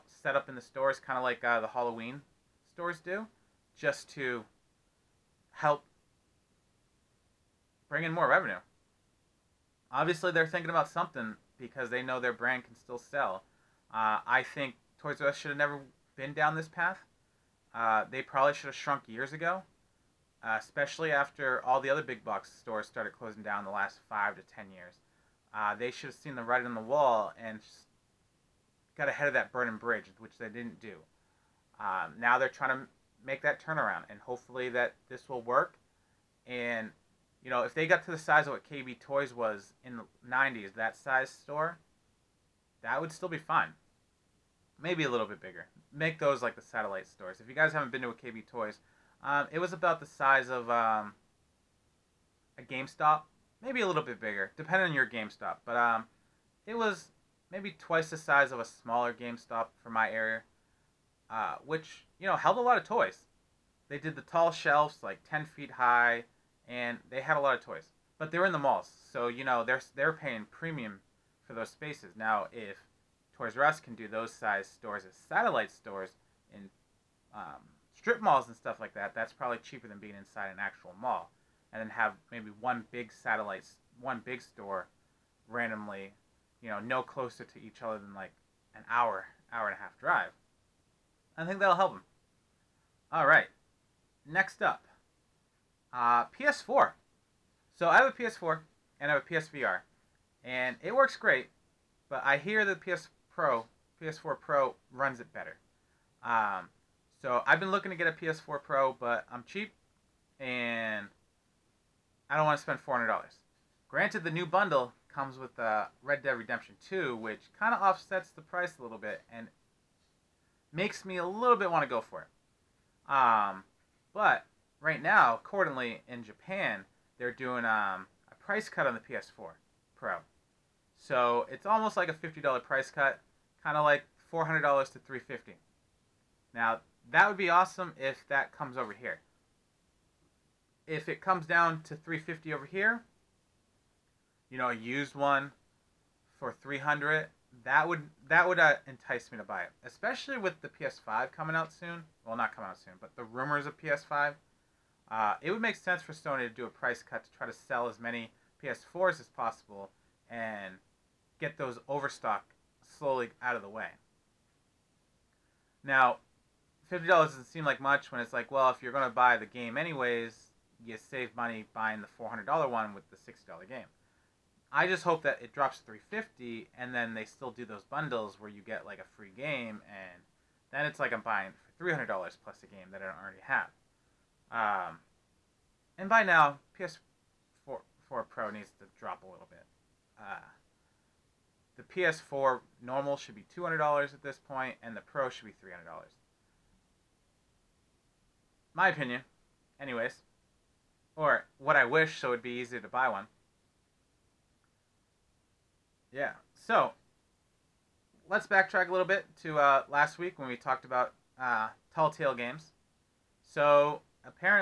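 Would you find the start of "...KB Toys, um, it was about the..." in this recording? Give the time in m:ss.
0:48.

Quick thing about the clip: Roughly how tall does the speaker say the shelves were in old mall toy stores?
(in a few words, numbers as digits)
10 feet.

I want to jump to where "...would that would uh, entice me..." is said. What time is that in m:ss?
2:27.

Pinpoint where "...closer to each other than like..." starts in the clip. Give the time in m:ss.
1:27.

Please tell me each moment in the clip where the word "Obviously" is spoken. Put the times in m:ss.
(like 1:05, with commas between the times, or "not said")
0:09.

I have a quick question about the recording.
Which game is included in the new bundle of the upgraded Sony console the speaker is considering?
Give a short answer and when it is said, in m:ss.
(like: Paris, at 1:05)
Red Dead Redemption 2, at 1:56.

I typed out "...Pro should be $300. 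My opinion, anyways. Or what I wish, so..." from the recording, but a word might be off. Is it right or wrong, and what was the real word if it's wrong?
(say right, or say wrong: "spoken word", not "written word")
right.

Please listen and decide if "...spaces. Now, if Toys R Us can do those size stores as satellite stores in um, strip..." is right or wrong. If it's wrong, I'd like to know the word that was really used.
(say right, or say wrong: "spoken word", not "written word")
right.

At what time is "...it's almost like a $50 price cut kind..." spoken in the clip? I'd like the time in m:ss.
2:11.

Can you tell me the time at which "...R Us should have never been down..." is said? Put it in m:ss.
0:15.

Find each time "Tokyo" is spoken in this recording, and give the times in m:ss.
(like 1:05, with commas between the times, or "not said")
not said.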